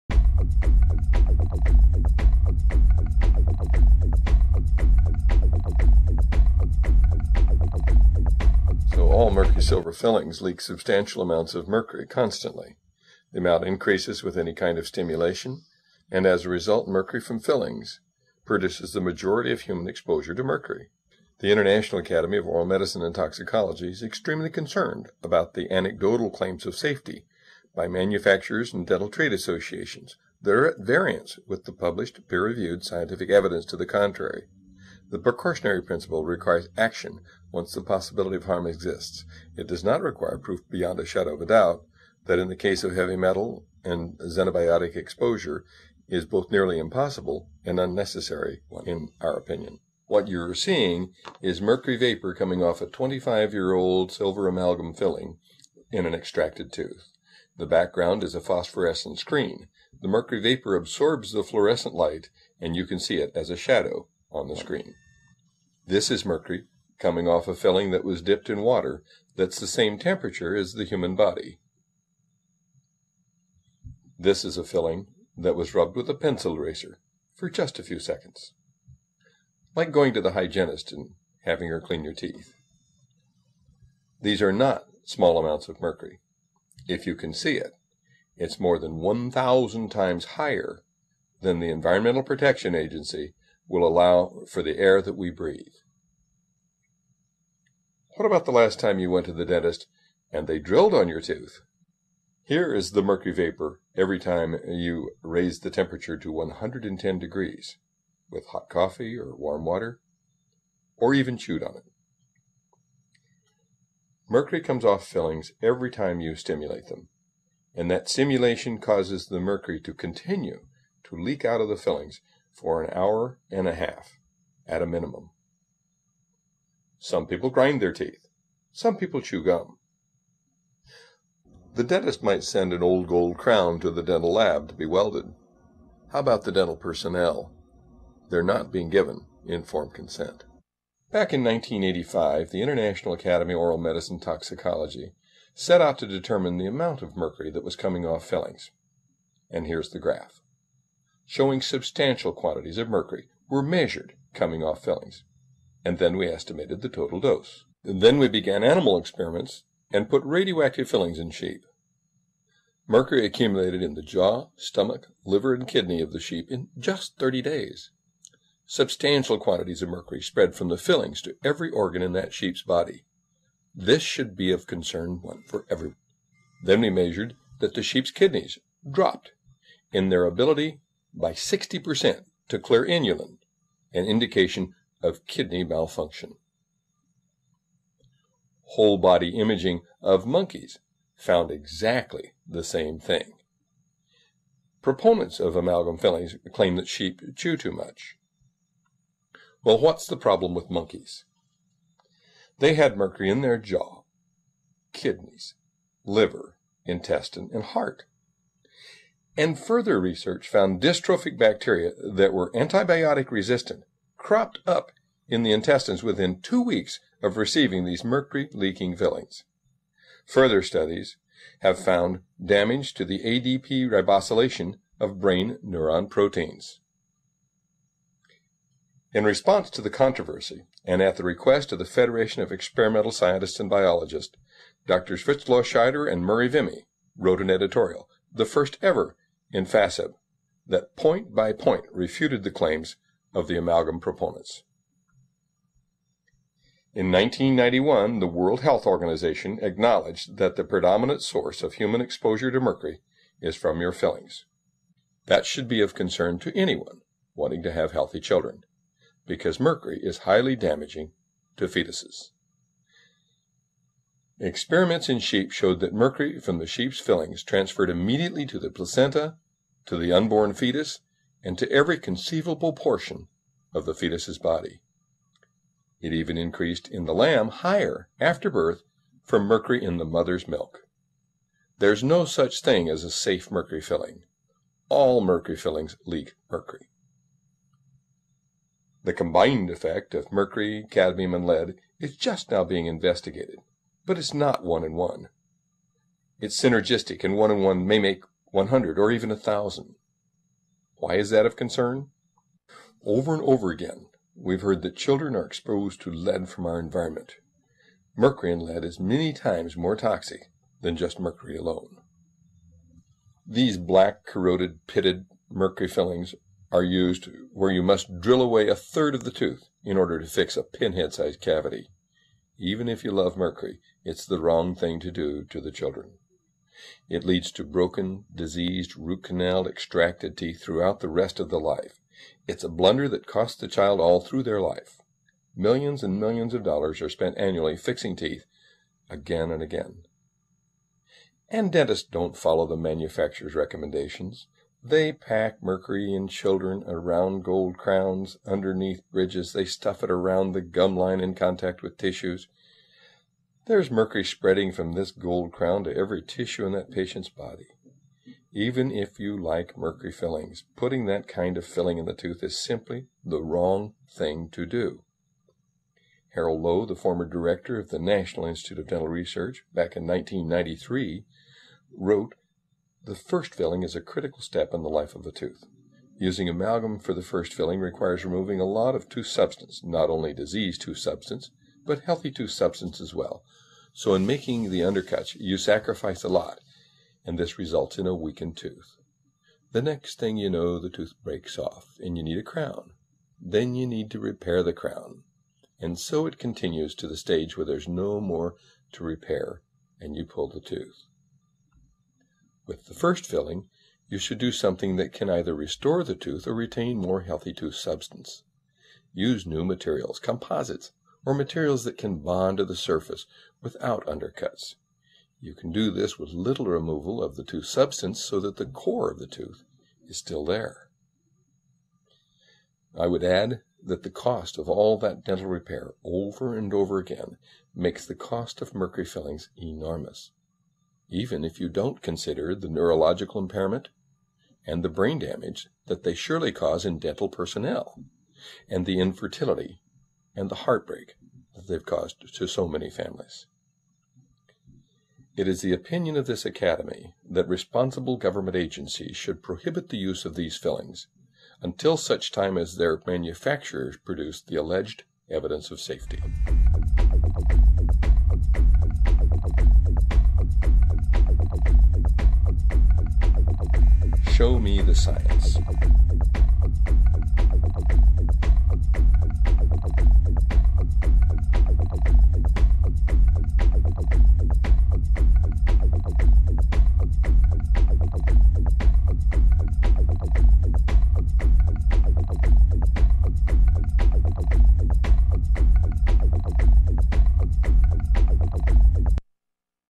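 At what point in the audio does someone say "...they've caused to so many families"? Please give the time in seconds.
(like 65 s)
441 s.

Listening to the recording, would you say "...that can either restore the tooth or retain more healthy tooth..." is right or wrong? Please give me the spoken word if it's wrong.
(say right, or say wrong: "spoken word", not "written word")
right.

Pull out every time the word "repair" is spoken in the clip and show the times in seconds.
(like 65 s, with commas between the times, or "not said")
394 s, 399 s, 425 s.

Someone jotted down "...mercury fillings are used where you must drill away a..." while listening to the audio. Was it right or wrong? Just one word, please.
right.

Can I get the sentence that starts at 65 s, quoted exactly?
This is mercury coming off a filling that was dipped in water that's the same temperature as the human body.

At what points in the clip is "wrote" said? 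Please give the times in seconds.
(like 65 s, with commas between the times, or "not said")
237 s, 371 s.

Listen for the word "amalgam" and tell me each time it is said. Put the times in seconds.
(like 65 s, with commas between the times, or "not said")
54 s, 195 s, 243 s, 376 s.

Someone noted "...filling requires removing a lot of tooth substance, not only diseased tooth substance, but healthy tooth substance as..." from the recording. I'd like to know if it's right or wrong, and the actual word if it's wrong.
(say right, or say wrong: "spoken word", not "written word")
right.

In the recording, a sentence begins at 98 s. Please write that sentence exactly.
What about the last time you went to the dentist and they drilled on your tooth?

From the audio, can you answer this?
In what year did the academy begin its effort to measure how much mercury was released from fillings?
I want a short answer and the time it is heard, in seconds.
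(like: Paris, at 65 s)
1985, at 141 s.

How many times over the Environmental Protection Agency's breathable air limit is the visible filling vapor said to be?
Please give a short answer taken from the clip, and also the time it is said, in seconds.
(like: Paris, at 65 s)
1,000, at 88 s.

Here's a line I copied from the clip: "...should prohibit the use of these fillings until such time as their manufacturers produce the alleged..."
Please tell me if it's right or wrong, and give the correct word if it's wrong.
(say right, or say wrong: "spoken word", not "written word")
right.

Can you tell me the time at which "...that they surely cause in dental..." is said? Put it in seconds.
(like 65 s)
435 s.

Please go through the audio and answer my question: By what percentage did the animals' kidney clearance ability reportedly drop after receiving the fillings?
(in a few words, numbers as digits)
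60%.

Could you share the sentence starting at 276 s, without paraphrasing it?
It even increased in the lamb higher after birth from mercury in the mother's milk.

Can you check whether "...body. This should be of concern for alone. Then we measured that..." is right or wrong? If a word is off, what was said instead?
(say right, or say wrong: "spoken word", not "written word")
wrong: "everyone", not "alone".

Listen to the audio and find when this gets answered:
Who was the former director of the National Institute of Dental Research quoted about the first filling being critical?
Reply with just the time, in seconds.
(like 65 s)
366 s.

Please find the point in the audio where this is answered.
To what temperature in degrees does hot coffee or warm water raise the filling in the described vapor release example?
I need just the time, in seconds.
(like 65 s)
106 s.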